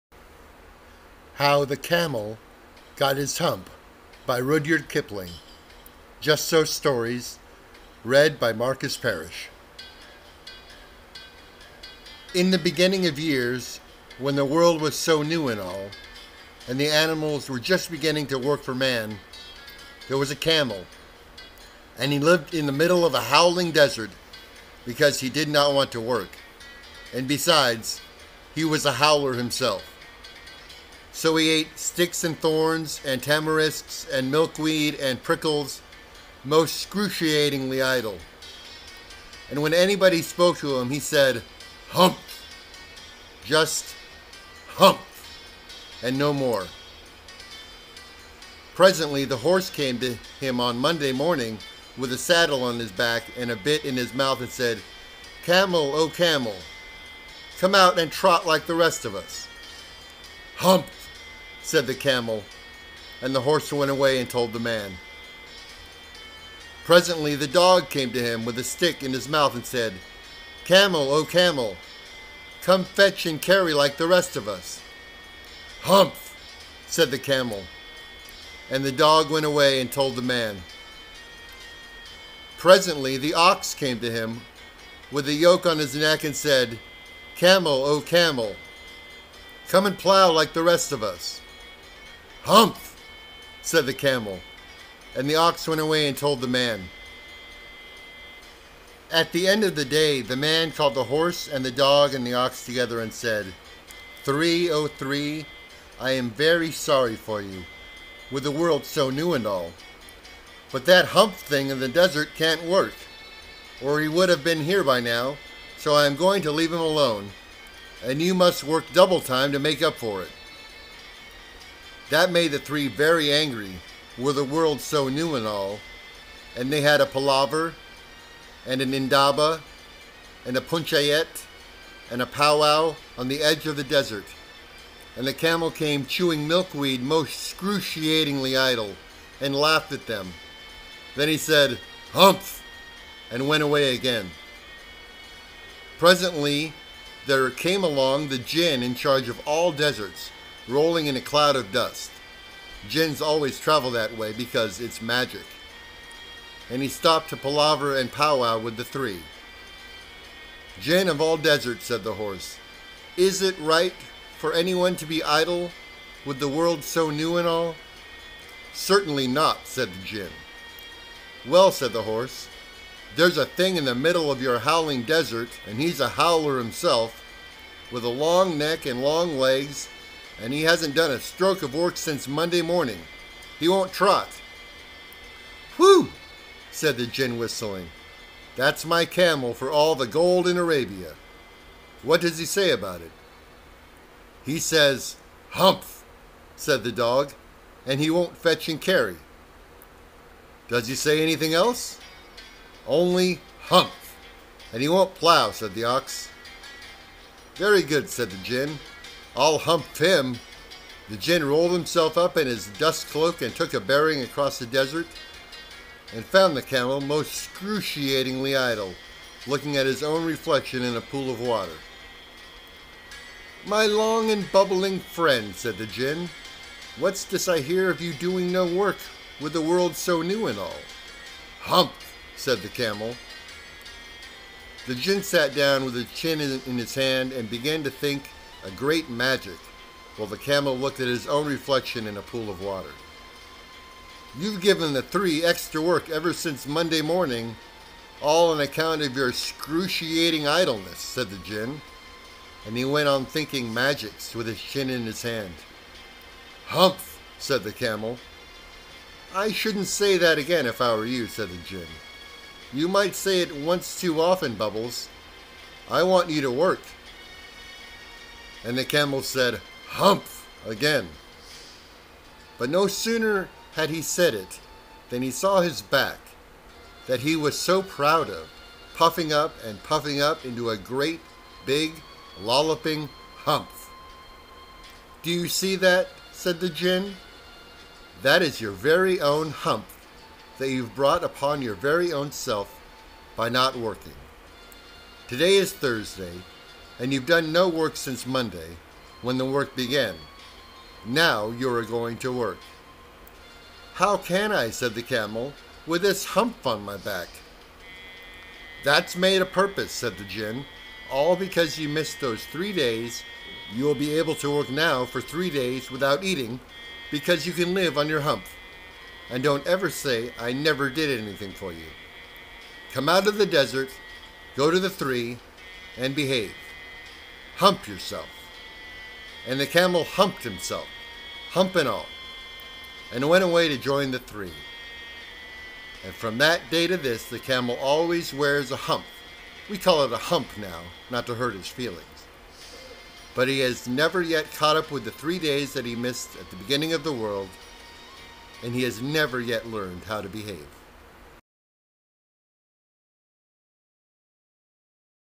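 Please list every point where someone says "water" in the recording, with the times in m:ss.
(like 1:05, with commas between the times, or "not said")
3:41, 4:02.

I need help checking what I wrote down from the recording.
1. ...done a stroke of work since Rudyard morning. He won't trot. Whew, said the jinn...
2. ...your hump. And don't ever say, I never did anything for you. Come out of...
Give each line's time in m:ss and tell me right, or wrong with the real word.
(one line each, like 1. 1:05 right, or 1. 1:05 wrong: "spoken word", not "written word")
1. 3:00 wrong: "Monday", not "Rudyard"
2. 5:18 right.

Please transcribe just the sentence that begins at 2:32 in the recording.
Jinns always travel that way because it's magic.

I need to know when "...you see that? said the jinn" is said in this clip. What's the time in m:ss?
4:45.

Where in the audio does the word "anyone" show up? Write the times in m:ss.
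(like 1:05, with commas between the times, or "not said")
2:44.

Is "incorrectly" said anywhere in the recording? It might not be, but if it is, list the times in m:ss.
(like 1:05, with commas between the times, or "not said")
not said.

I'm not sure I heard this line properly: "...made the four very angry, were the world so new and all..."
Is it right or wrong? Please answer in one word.
wrong.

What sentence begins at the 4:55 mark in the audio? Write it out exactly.
Today is Thursday, and you've done no work since Monday, when the work began.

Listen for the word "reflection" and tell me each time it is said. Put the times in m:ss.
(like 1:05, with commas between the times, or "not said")
3:40, 4:01.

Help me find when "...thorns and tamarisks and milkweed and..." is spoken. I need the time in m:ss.
0:32.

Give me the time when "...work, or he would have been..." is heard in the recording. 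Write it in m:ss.
1:52.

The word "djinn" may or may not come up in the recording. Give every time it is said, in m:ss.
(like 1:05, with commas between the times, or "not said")
4:11, 4:21.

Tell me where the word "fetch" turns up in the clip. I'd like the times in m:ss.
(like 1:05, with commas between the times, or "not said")
1:12, 3:18.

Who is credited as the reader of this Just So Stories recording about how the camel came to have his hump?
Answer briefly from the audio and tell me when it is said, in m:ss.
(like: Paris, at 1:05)
Marcus Parrish, at 0:08.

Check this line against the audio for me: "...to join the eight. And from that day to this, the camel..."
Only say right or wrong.
wrong.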